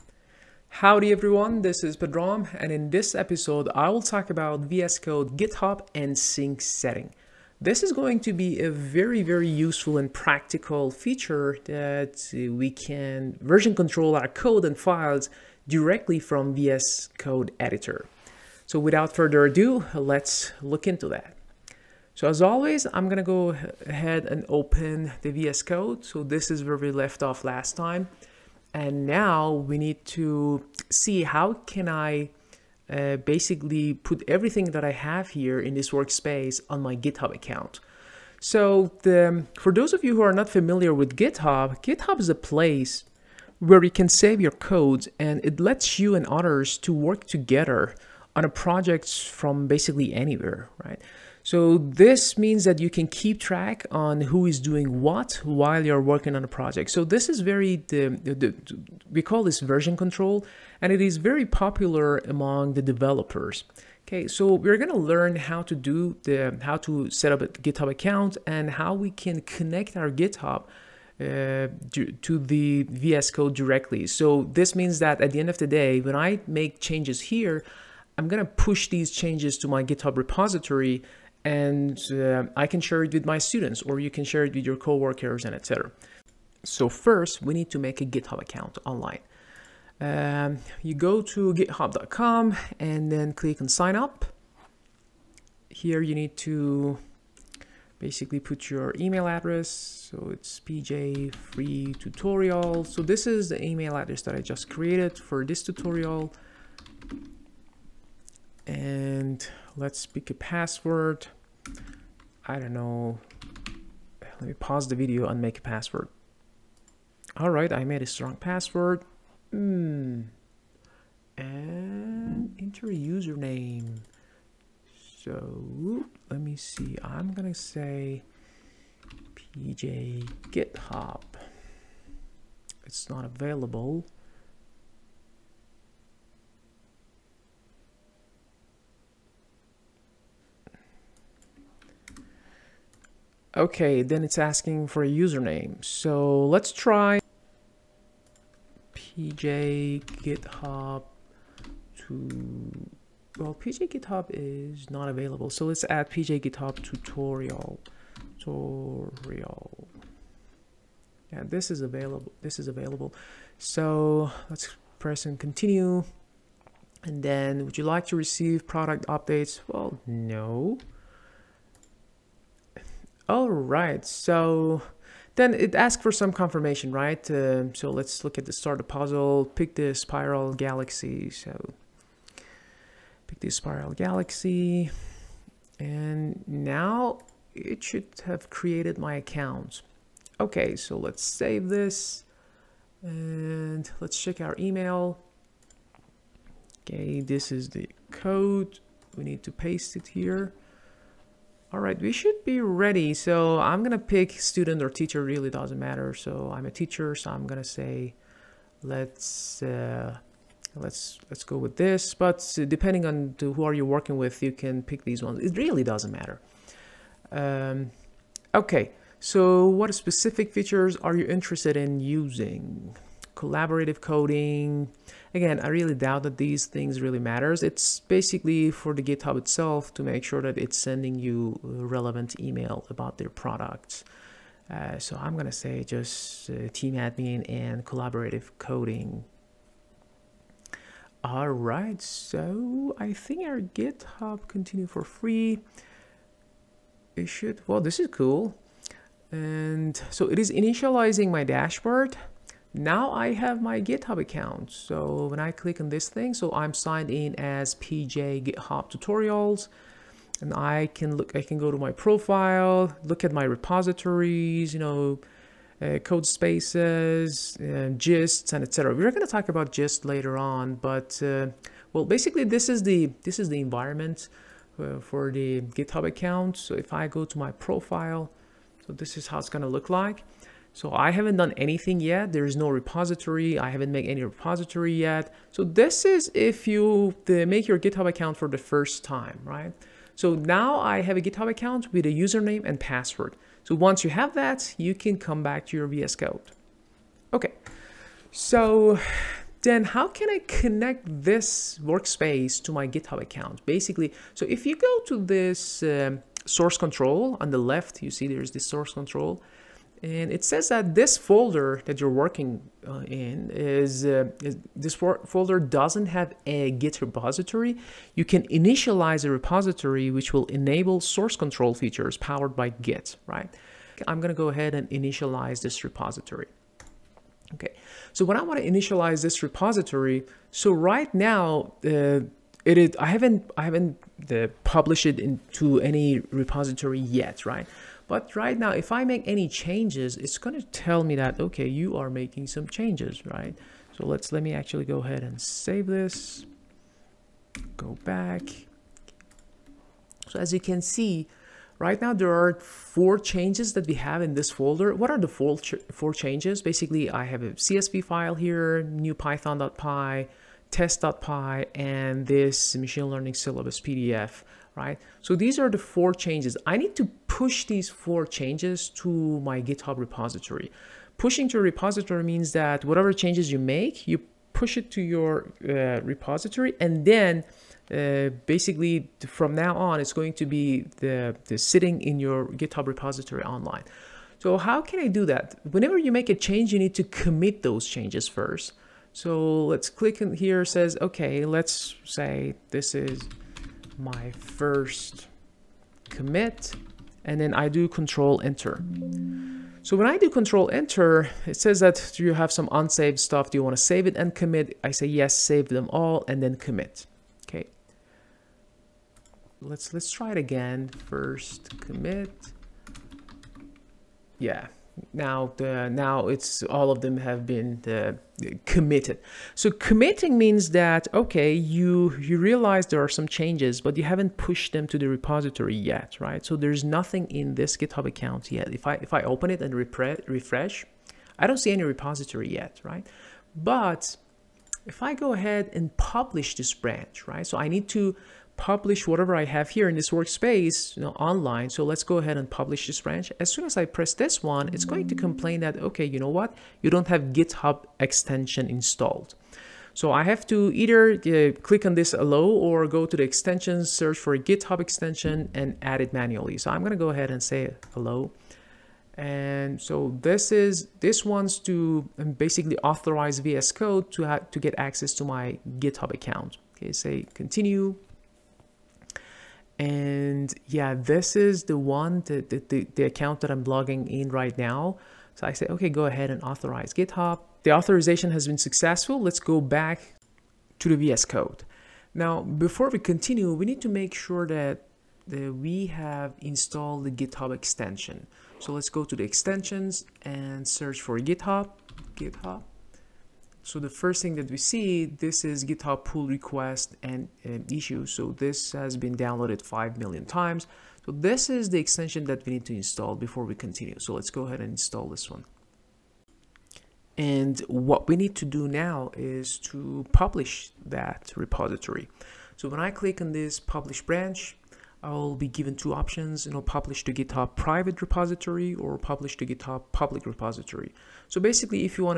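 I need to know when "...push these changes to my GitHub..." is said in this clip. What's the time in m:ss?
1:18.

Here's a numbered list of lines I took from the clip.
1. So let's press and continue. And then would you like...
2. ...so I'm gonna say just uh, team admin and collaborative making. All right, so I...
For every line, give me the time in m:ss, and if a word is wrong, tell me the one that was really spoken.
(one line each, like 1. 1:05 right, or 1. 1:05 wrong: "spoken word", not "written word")
1. 2:43 right
2. 3:54 wrong: "coding", not "making".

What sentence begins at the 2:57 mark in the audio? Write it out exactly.
Uh, so let's look at the start of the puzzle.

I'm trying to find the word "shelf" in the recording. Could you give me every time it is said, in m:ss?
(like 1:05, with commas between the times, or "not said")
not said.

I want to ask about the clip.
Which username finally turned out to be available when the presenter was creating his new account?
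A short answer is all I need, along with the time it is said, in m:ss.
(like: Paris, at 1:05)
pj github tutorial, at 2:36.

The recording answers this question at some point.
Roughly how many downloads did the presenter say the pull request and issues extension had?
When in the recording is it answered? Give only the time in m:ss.
8:19.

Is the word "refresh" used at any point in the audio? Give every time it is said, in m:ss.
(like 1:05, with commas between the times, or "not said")
7:09.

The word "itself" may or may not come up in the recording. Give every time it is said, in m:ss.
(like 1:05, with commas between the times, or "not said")
3:49.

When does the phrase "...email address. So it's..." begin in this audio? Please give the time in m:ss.
1:38.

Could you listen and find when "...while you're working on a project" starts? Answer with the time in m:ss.
0:55.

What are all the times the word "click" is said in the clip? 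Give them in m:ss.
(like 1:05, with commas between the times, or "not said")
1:33, 4:15, 6:29, 7:31, 8:32.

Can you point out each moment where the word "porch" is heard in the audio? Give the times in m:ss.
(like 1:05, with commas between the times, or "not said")
not said.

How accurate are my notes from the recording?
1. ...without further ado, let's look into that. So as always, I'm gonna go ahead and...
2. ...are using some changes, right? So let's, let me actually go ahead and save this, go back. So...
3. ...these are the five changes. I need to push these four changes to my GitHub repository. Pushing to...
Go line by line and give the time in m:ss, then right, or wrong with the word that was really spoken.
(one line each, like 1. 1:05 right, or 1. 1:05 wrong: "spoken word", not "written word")
1. 0:18 right
2. 5:41 wrong: "making", not "using"
3. 6:05 wrong: "four", not "five".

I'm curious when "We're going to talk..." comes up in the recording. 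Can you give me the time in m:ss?
4:28.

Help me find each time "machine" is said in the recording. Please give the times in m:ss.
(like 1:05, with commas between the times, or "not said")
6:02.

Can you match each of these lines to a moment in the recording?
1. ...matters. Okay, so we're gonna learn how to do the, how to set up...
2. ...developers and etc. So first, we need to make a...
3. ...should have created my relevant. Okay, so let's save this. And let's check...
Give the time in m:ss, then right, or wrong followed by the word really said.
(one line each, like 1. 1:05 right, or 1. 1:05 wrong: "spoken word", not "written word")
1. 1:02 wrong: "developers", not "matters"
2. 1:24 wrong: "coworkers", not "developers"
3. 3:07 wrong: "account", not "relevant".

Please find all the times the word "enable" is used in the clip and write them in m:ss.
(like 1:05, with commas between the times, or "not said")
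5:20.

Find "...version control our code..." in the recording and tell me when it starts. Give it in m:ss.
0:13.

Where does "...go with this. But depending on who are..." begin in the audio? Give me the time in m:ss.
3:31.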